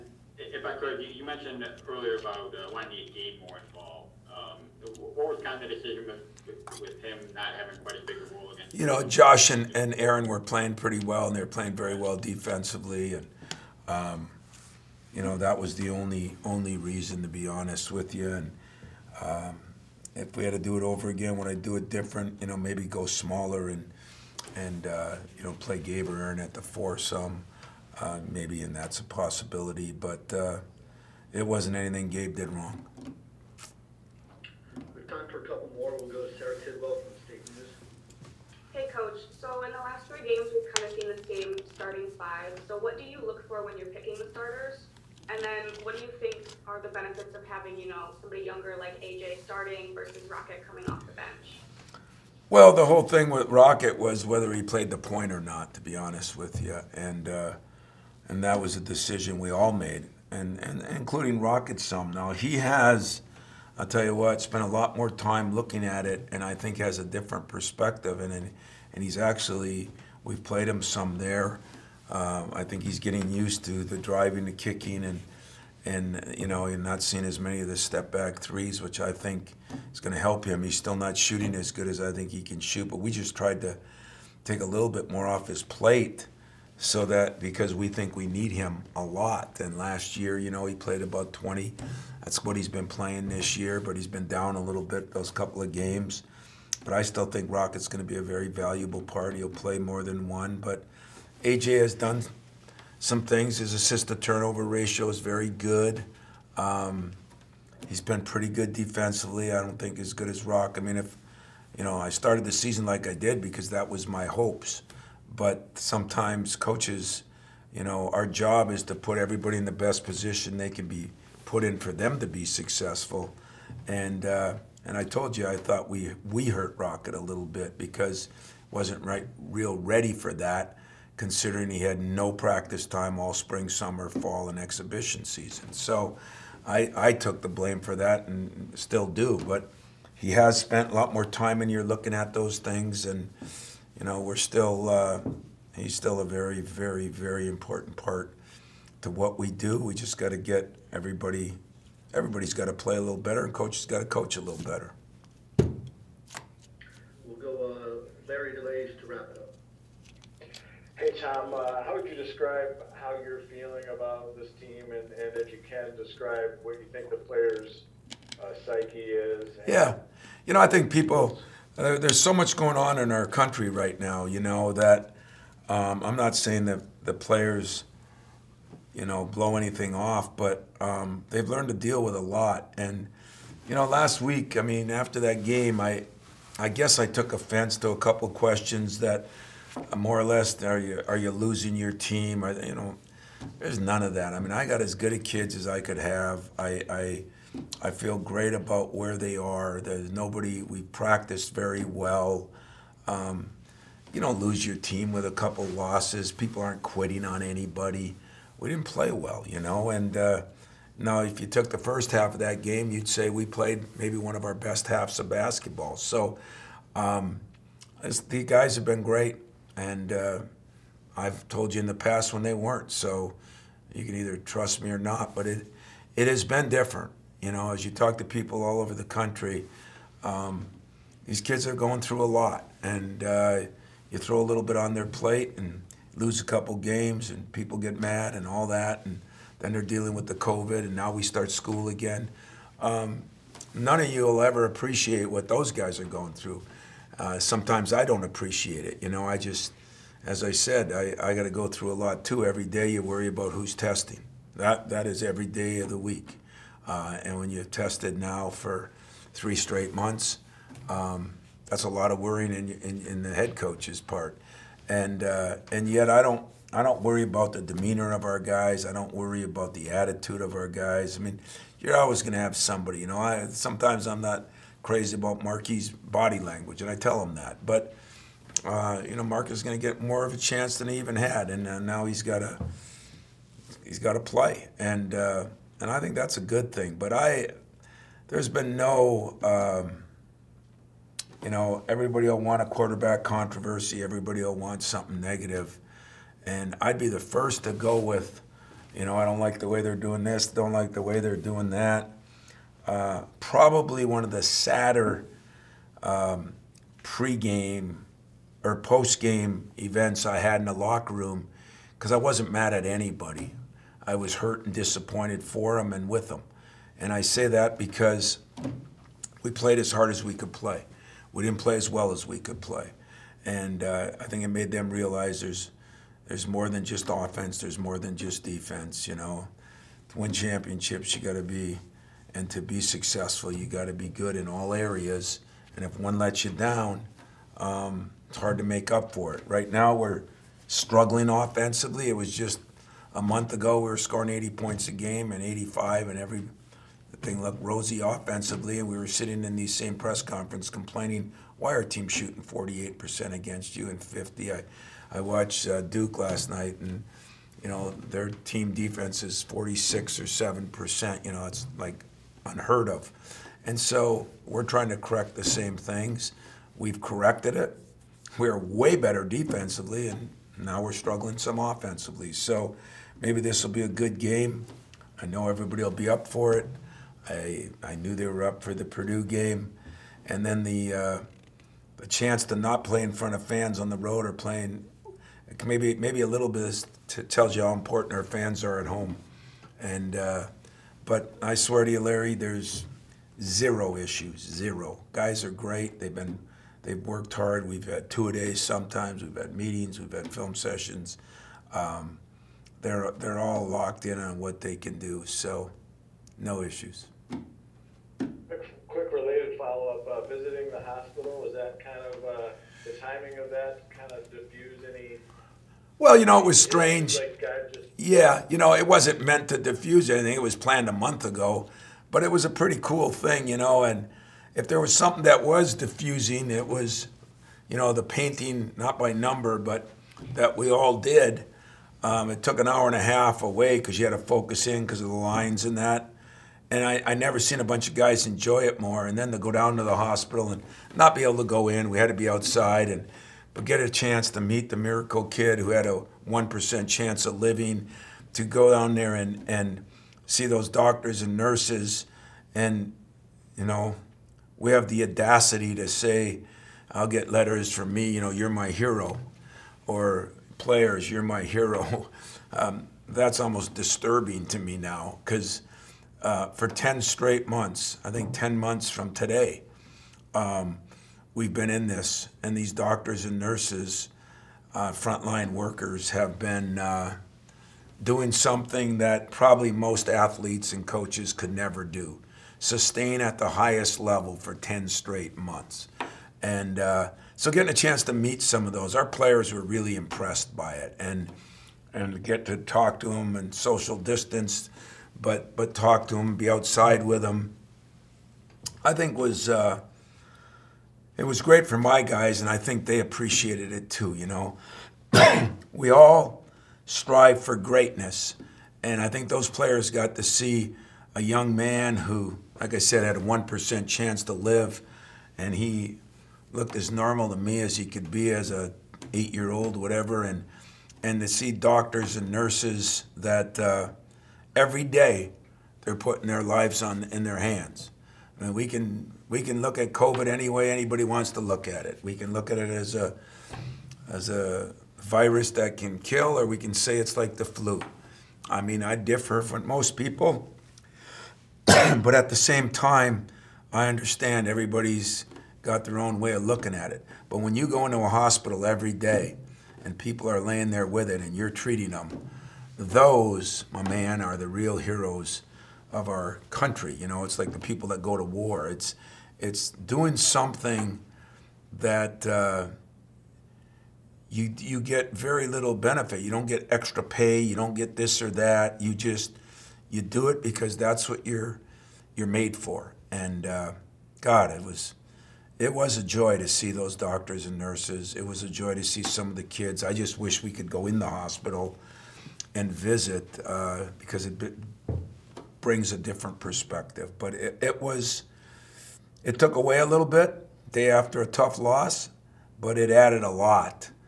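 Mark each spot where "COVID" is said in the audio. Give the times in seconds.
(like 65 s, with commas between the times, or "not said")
240 s, 529 s.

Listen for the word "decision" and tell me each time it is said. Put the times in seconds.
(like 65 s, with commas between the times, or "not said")
5 s, 58 s.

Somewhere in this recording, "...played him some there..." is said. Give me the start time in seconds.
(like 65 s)
70 s.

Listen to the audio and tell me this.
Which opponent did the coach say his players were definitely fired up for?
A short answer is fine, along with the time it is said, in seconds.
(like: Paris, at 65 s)
Purdue, at 378 s.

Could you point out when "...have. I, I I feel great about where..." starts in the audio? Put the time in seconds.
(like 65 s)
195 s.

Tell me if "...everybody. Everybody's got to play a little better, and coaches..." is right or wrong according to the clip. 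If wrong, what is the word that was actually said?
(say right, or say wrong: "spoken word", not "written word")
right.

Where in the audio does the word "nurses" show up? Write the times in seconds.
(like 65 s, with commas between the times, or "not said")
451 s, 473 s, 522 s, 577 s.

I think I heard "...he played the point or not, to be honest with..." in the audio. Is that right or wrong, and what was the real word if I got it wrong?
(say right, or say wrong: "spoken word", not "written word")
right.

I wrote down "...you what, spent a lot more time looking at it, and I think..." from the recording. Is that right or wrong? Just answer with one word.
right.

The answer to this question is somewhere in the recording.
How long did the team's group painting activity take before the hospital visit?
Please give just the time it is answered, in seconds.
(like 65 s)
432 s.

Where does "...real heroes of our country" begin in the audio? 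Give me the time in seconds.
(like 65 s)
554 s.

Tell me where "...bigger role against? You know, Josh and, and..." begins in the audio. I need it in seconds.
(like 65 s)
8 s.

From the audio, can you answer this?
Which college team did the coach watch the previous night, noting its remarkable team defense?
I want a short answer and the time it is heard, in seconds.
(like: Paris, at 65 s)
Duke, at 355 s.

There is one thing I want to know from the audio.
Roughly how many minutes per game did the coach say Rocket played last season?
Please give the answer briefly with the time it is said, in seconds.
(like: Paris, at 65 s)
20, at 90 s.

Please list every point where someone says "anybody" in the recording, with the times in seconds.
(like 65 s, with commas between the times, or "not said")
207 s, 312 s, 530 s.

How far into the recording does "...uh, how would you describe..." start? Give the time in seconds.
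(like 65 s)
161 s.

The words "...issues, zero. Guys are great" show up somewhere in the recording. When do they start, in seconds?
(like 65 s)
393 s.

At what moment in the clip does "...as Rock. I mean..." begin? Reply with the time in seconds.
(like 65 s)
110 s.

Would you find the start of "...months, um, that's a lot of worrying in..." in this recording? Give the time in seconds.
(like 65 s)
259 s.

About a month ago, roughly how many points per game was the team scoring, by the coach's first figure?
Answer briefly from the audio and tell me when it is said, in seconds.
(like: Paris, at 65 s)
80, at 344 s.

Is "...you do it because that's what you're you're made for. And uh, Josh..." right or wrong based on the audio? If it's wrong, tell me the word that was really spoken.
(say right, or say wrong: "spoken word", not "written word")
wrong: "God", not "Josh".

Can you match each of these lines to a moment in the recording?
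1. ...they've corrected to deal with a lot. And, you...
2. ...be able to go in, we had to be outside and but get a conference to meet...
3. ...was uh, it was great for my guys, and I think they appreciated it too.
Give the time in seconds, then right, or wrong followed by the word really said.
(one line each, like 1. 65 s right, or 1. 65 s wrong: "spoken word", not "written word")
1. 181 s wrong: "learned", not "corrected"
2. 441 s wrong: "chance", not "conference"
3. 499 s right.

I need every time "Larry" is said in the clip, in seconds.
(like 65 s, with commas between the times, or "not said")
158 s, 392 s.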